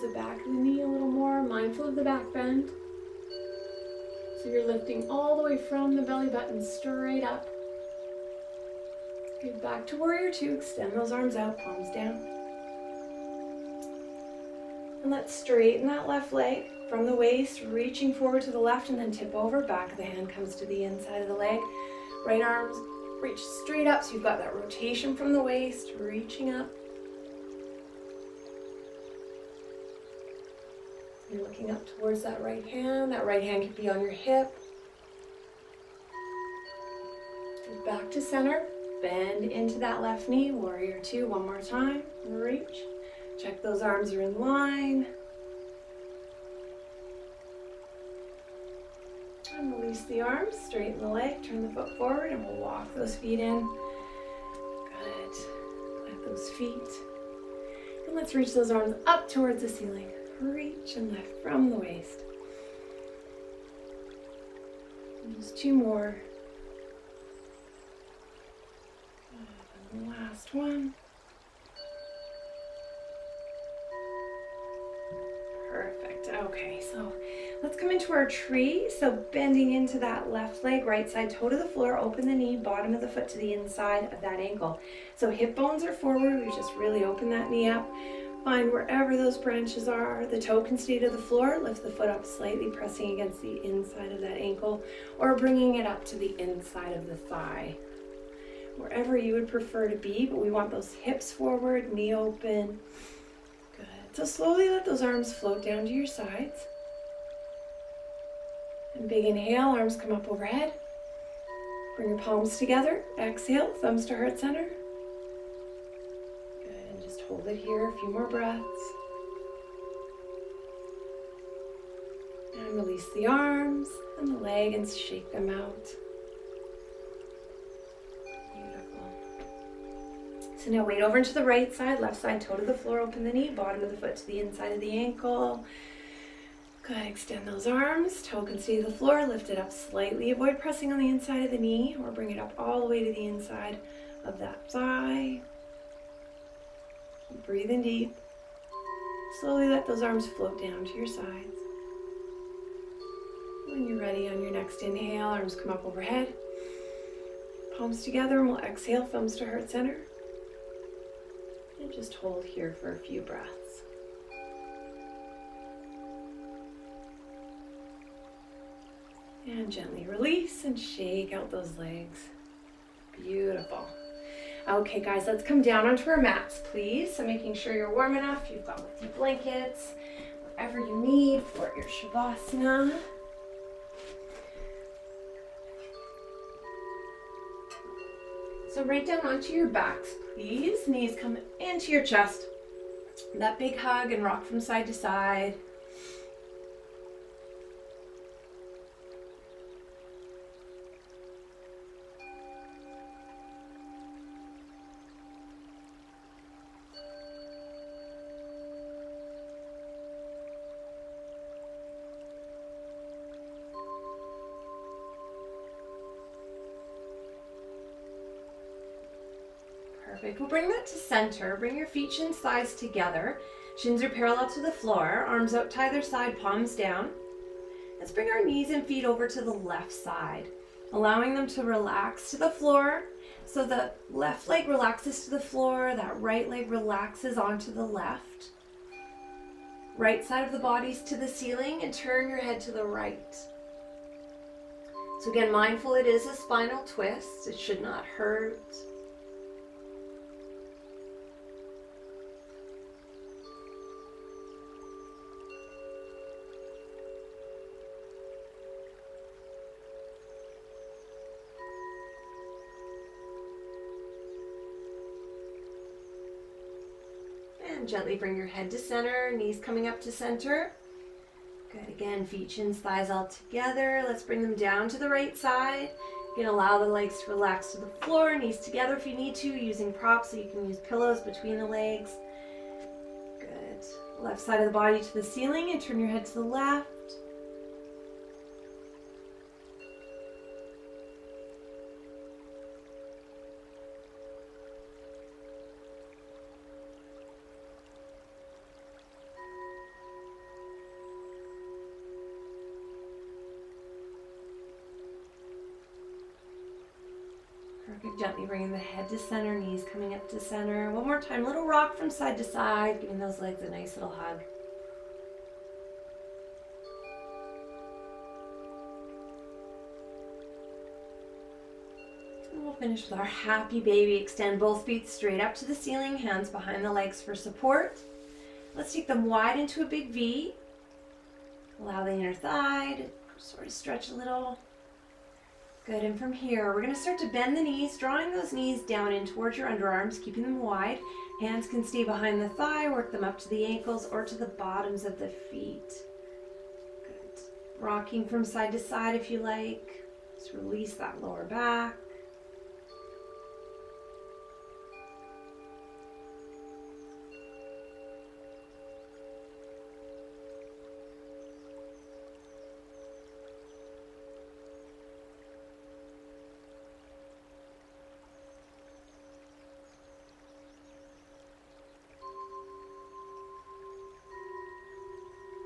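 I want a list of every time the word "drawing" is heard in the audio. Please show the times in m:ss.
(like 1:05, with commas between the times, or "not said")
5:37.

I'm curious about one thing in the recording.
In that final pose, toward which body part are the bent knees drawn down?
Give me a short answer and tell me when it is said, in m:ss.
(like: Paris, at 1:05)
Underarms, at 5:39.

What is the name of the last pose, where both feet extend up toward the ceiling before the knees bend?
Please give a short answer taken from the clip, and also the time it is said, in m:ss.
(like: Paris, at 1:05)
Happy baby, at 5:23.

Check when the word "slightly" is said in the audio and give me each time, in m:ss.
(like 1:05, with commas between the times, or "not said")
1:32, 2:19.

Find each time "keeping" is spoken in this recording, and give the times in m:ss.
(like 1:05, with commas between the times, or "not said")
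5:40.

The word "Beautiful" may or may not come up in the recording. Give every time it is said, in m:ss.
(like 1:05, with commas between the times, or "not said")
2:08, 2:53.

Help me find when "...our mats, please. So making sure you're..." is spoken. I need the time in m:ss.
2:56.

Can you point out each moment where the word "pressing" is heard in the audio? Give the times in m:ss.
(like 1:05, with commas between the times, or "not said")
1:32, 2:20.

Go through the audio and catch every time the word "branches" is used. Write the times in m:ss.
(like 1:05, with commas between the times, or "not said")
1:29.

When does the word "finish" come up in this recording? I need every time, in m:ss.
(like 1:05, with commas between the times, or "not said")
5:22.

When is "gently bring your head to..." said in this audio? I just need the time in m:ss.
4:27.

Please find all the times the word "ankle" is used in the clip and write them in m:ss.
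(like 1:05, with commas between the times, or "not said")
1:24, 1:34, 2:14, 5:43.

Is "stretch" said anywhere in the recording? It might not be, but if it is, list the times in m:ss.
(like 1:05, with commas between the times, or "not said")
5:33.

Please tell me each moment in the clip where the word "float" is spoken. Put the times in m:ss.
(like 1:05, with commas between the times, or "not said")
1:45, 2:30.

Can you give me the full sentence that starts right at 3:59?
Right side of the body's to the ceiling and turn your head to the right.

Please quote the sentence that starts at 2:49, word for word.
And gently release and shake out those legs.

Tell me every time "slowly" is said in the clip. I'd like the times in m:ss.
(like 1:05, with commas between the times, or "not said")
1:44, 2:29.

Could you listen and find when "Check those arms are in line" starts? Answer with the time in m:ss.
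0:43.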